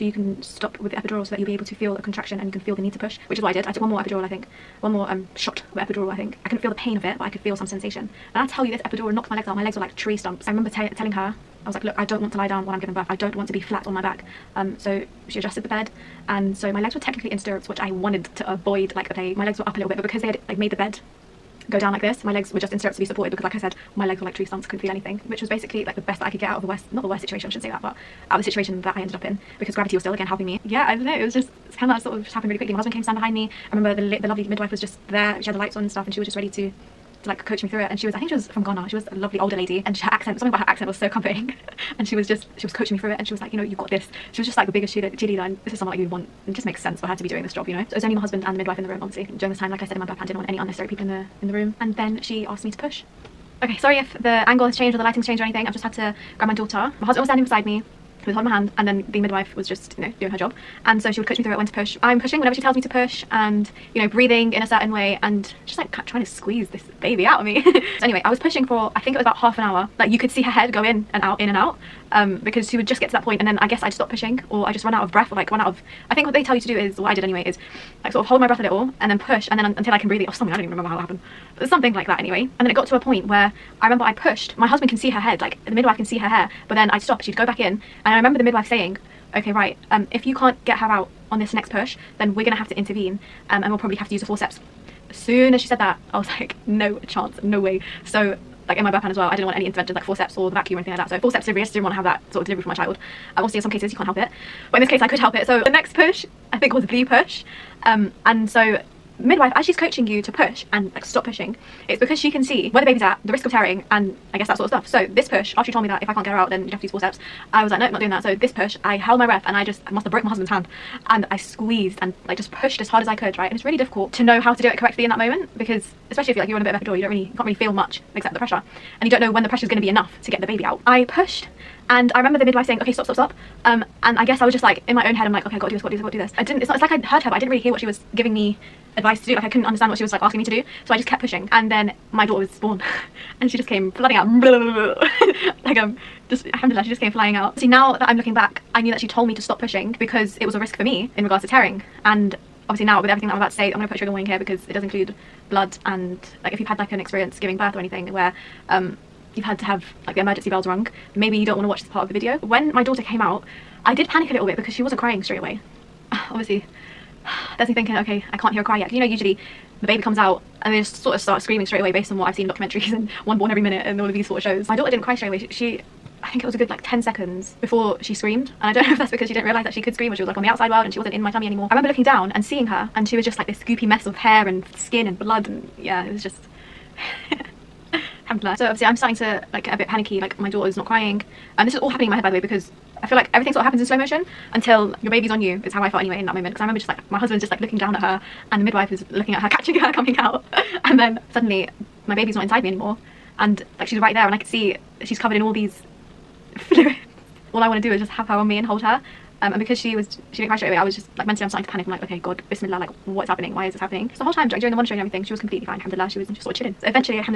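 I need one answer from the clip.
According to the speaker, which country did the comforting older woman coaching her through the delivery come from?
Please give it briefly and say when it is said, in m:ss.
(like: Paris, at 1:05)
Ghana, at 0:38.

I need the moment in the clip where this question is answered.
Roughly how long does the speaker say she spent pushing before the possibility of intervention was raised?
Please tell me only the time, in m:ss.
1:09.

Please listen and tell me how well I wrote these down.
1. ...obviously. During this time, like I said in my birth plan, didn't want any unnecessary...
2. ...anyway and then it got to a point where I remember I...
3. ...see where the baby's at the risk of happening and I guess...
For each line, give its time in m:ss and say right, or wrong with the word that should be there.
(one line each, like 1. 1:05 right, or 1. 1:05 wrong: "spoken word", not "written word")
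1. 0:49 right
2. 1:22 right
3. 1:52 wrong: "tearing", not "happening".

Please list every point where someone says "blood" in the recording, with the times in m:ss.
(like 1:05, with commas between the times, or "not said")
2:35, 3:05.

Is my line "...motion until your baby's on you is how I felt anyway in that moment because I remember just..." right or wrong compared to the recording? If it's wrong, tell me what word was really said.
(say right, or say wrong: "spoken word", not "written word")
right.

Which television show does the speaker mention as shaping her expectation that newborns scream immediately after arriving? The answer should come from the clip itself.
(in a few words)
One Born Every Minute.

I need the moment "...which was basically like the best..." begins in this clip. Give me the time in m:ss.
0:25.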